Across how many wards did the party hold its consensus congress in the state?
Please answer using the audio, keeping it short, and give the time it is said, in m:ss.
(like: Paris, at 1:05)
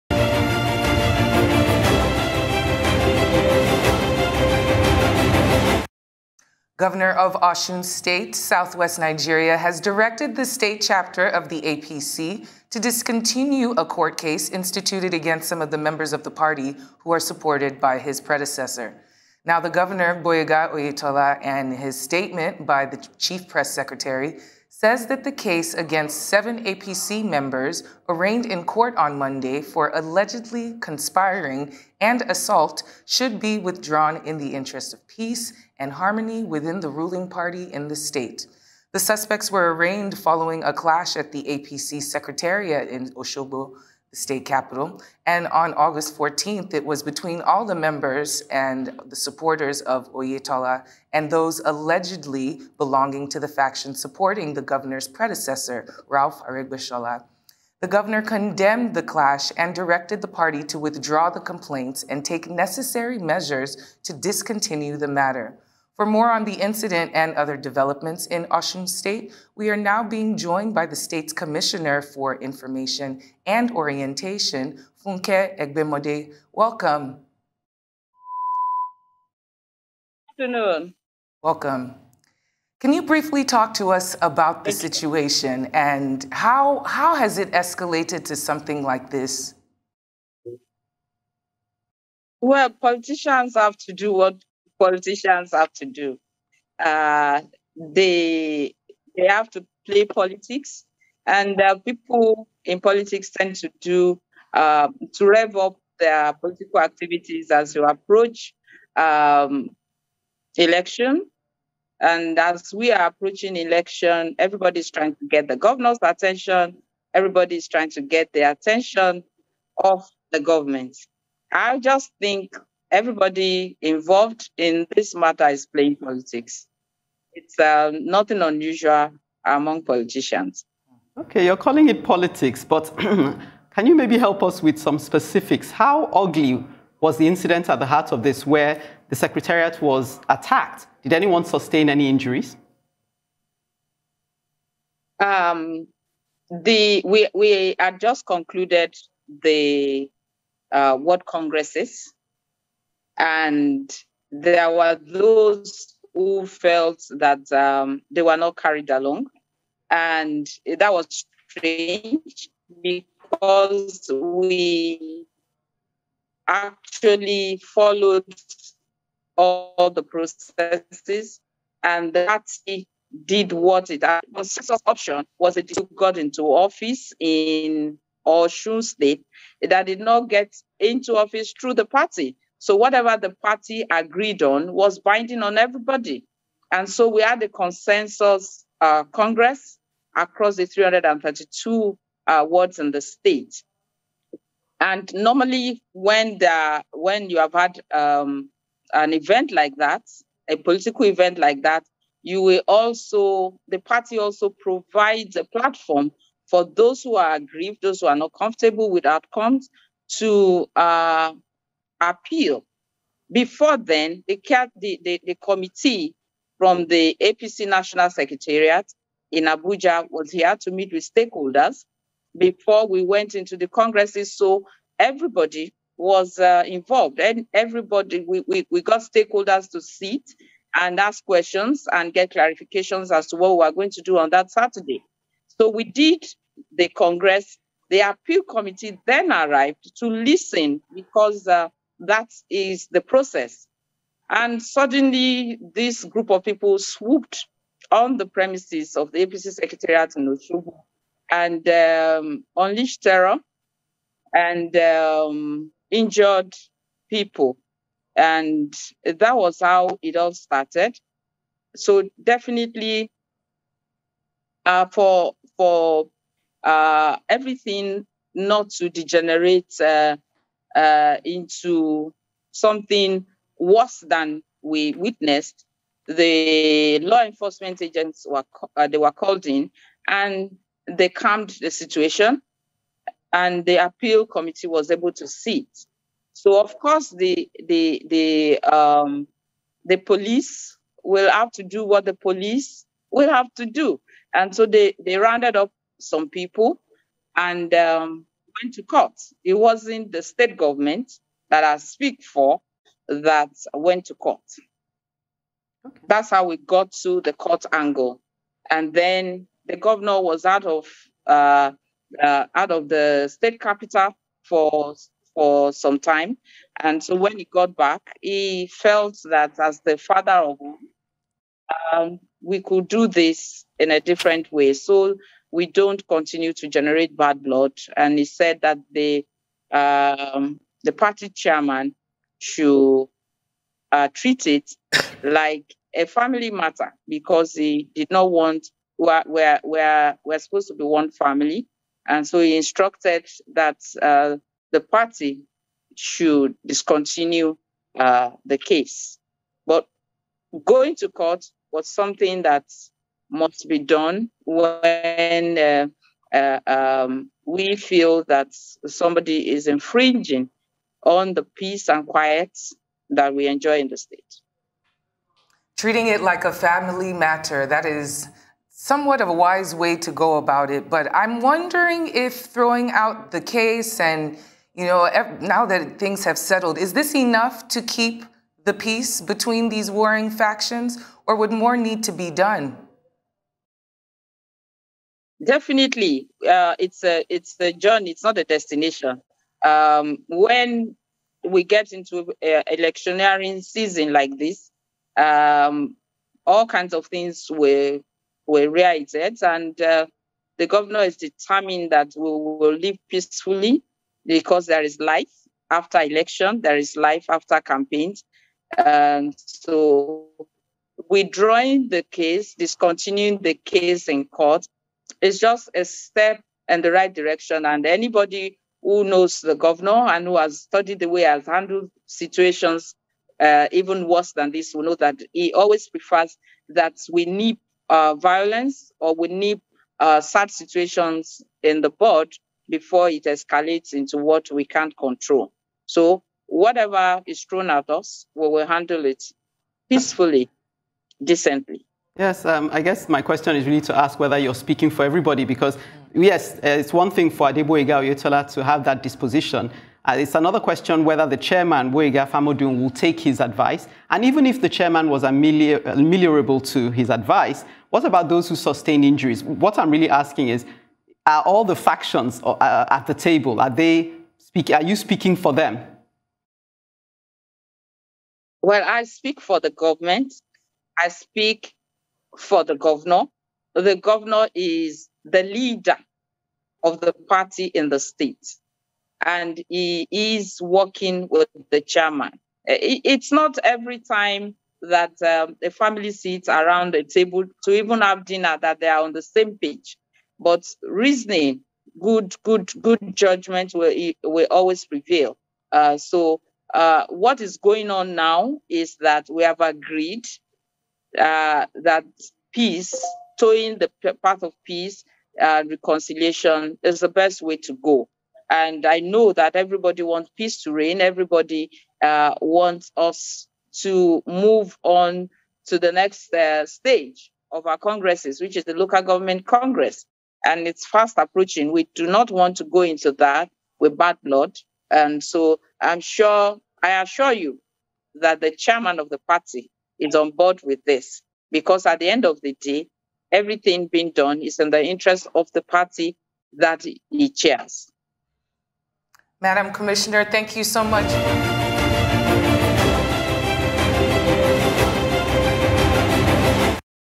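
332, at 3:10.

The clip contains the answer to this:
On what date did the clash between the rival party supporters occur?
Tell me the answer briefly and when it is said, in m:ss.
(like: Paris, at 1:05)
August 14th, at 0:45.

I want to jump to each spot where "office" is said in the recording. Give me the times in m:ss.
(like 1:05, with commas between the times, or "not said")
2:56, 3:01.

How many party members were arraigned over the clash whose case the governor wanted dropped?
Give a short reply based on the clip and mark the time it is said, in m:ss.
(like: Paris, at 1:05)
7, at 0:26.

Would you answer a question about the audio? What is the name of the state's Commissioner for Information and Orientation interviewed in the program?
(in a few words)
Funke Egbemode.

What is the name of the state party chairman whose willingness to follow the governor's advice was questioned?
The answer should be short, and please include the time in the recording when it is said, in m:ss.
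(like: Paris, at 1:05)
Gboyega Famodun, at 7:31.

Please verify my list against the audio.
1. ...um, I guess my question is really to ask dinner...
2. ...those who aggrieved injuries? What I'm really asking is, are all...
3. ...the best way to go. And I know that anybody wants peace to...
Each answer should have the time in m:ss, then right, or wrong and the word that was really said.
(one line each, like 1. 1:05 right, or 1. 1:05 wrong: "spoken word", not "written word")
1. 7:22 wrong: "whether", not "dinner"
2. 7:38 wrong: "sustained", not "aggrieved"
3. 8:26 wrong: "everybody", not "anybody".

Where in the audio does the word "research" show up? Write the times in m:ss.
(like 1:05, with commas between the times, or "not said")
not said.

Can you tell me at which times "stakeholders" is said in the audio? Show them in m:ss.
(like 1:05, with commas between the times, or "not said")
3:41, 3:49.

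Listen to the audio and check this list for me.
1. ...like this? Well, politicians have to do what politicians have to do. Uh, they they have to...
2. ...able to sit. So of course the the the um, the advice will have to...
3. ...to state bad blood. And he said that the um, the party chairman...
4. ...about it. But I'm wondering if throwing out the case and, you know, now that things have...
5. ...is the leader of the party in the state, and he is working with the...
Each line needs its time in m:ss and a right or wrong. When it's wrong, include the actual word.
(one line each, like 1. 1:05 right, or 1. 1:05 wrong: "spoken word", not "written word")
1. 1:28 right
2. 4:44 wrong: "police", not "advice"
3. 5:26 wrong: "generate", not "state"
4. 6:10 right
5. 7:54 right.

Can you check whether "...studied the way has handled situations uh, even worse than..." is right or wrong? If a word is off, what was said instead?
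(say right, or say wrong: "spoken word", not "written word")
right.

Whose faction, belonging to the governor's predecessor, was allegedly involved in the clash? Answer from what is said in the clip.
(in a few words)
Rauf Aregbesola.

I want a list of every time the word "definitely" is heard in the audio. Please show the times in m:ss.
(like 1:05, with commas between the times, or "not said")
4:22, 6:25.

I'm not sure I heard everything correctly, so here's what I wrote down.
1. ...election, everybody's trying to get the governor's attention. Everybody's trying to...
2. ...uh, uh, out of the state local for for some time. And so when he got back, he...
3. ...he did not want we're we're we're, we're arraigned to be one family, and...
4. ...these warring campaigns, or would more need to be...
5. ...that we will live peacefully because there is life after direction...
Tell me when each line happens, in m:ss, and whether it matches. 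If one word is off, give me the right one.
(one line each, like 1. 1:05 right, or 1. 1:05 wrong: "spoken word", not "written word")
1. 1:53 right
2. 5:11 wrong: "capital", not "local"
3. 5:37 wrong: "supposed", not "arraigned"
4. 6:19 wrong: "factions", not "campaigns"
5. 6:41 wrong: "election", not "direction".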